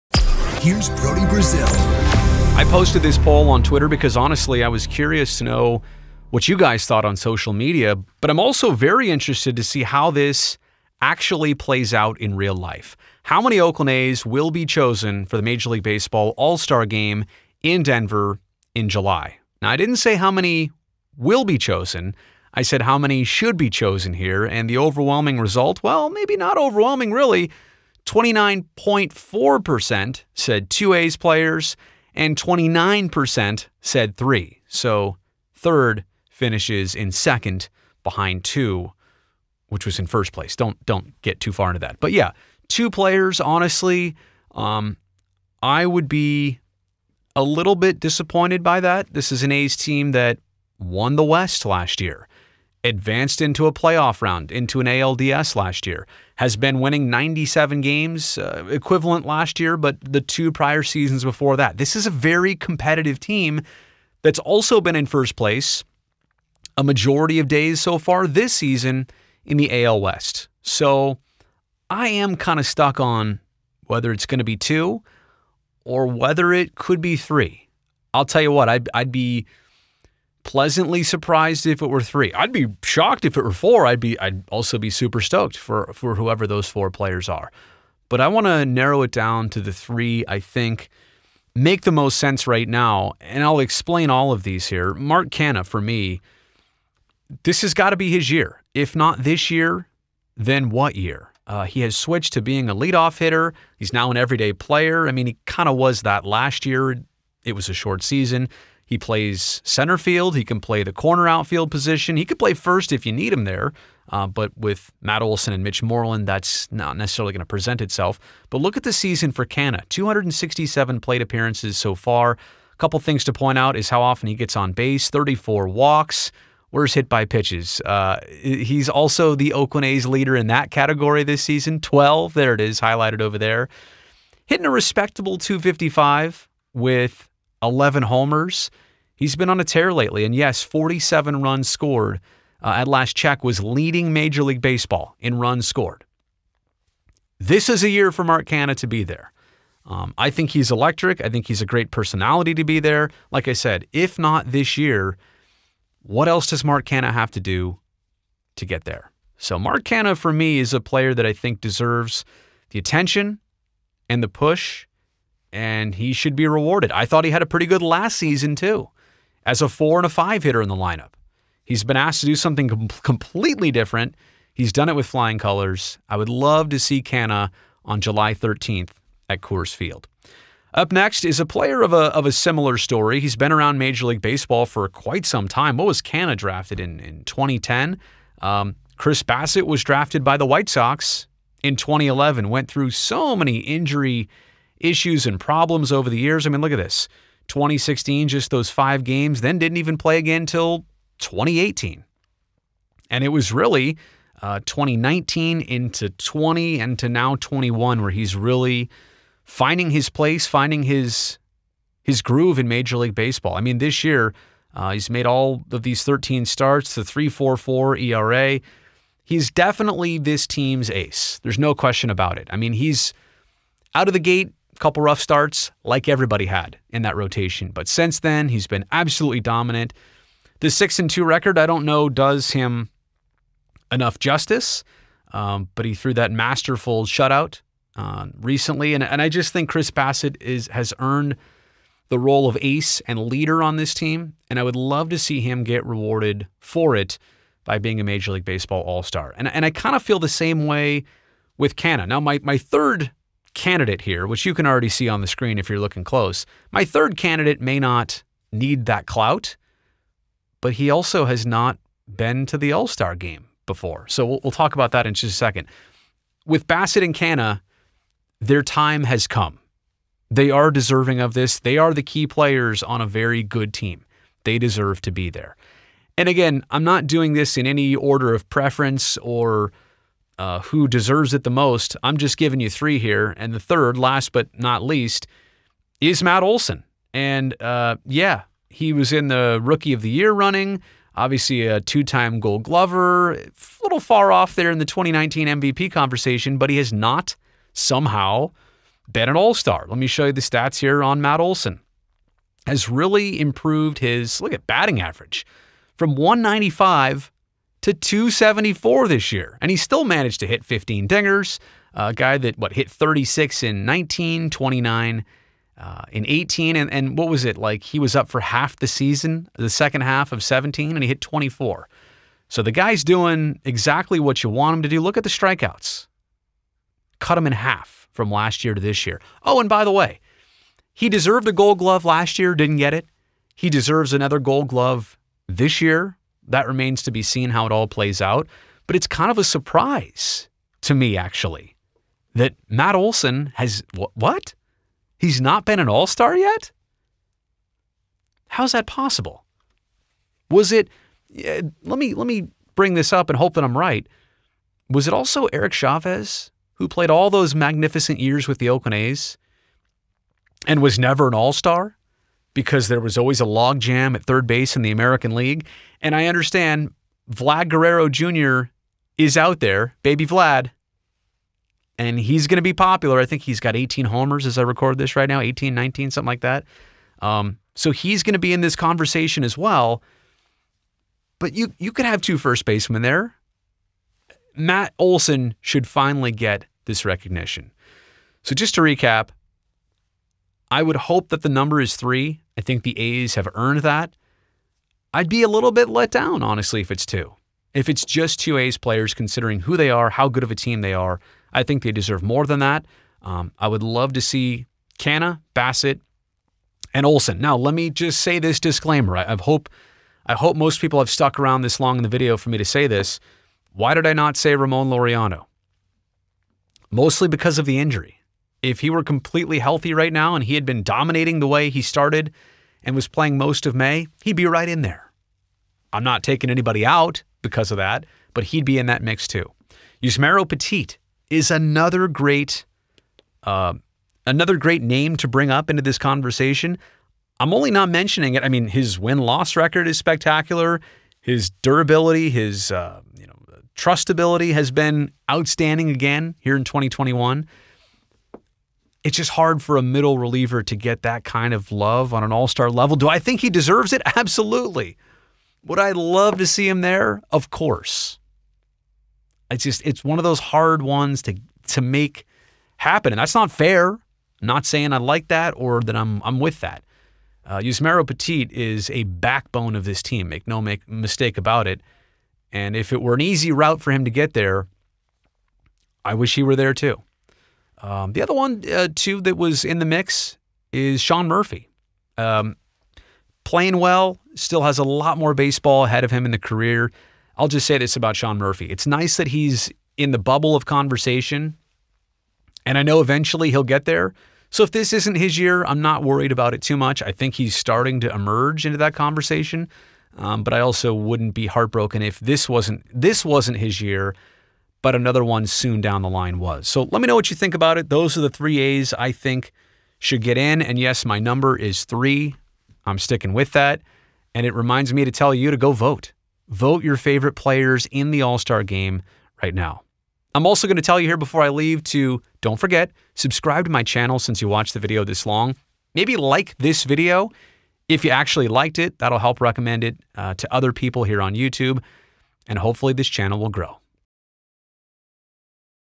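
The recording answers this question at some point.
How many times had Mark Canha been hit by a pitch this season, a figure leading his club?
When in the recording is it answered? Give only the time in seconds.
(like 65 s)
131 s.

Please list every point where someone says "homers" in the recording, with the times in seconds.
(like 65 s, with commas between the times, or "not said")
138 s, 374 s.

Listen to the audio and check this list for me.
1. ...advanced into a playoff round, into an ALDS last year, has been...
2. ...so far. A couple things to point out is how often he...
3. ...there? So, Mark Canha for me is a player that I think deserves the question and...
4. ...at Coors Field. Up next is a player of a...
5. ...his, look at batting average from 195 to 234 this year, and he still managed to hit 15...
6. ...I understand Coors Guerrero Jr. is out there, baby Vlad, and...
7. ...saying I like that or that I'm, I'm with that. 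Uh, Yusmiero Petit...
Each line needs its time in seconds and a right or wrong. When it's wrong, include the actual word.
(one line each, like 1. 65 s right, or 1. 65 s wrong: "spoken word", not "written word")
1. 52 s right
2. 121 s right
3. 158 s wrong: "attention", not "question"
4. 179 s right
5. 303 s wrong: "274", not "234"
6. 366 s wrong: "Vlad", not "Coors"
7. 464 s right.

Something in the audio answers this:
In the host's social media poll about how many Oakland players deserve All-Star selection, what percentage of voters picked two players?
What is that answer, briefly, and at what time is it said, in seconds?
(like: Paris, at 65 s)
29.4%, at 28 s.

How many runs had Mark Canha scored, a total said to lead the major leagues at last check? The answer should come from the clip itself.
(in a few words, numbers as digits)
47.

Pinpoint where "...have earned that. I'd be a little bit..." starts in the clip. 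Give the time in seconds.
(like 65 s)
393 s.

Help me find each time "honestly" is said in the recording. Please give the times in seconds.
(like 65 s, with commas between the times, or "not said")
4 s, 43 s, 396 s.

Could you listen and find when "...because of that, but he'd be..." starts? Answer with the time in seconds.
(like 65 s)
427 s.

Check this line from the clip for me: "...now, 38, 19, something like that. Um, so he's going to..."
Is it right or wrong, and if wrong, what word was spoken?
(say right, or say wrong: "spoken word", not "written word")
wrong: "18", not "38".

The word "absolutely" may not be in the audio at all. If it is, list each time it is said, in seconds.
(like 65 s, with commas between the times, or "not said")
228 s, 454 s.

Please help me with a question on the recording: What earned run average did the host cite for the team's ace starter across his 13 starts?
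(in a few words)
3.44.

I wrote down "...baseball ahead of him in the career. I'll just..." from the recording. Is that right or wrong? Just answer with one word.
right.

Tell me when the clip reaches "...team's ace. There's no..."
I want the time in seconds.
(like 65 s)
220 s.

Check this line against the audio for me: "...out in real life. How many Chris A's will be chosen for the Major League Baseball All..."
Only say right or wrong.
wrong.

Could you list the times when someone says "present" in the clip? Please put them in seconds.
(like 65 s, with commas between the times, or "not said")
117 s.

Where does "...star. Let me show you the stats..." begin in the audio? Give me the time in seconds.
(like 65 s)
299 s.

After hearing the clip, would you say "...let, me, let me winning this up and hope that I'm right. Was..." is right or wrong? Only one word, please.
wrong.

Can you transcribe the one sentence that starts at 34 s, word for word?
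So third finishes in second behind 2, which was in first place.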